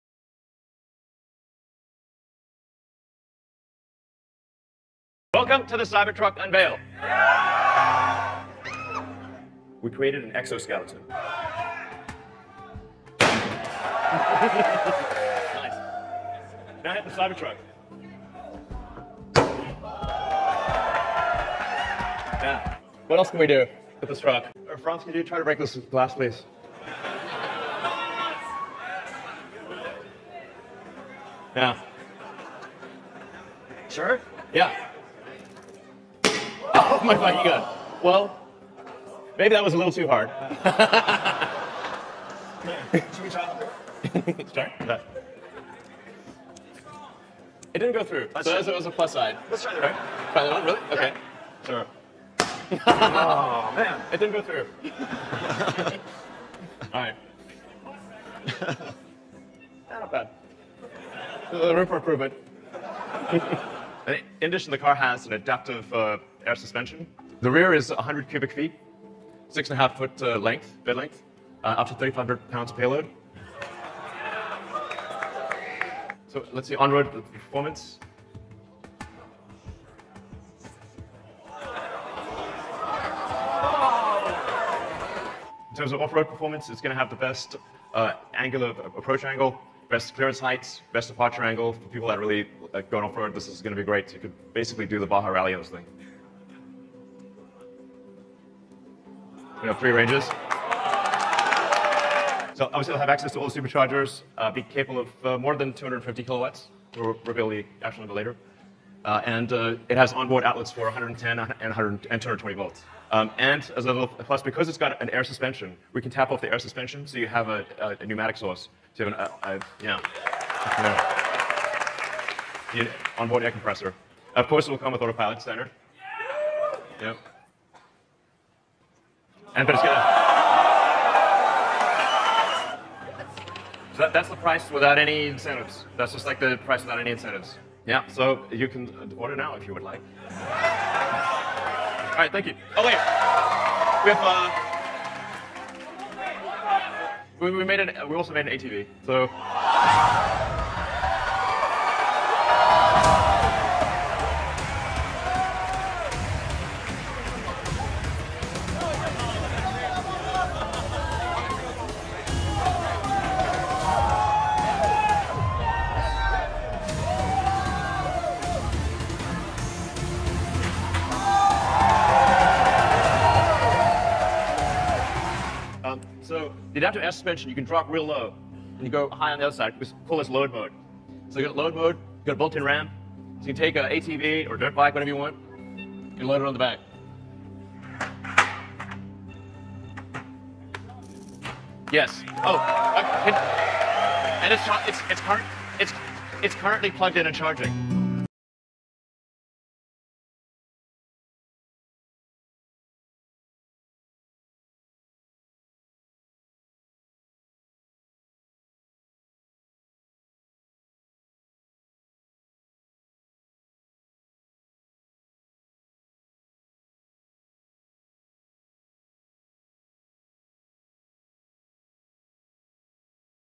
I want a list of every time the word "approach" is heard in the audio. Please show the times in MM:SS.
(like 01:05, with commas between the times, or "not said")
01:28.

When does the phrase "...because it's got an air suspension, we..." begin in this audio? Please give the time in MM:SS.
01:54.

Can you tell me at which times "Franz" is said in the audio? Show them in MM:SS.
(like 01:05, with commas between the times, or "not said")
00:24.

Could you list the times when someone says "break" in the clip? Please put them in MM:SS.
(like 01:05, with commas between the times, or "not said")
00:25.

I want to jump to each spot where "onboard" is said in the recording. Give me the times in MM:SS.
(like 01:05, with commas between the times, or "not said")
01:50, 02:03.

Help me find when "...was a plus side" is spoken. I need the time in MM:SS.
00:48.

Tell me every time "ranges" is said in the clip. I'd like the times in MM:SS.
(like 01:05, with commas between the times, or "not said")
01:39.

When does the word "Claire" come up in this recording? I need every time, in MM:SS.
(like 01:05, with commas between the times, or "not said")
not said.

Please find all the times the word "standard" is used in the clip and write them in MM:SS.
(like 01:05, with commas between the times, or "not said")
02:05.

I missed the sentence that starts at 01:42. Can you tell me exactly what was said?
So obviously, they'll have access to all the superchargers, uh, be capable of uh, more than 250 kilowatts.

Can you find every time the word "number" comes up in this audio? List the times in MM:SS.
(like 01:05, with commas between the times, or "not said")
01:48.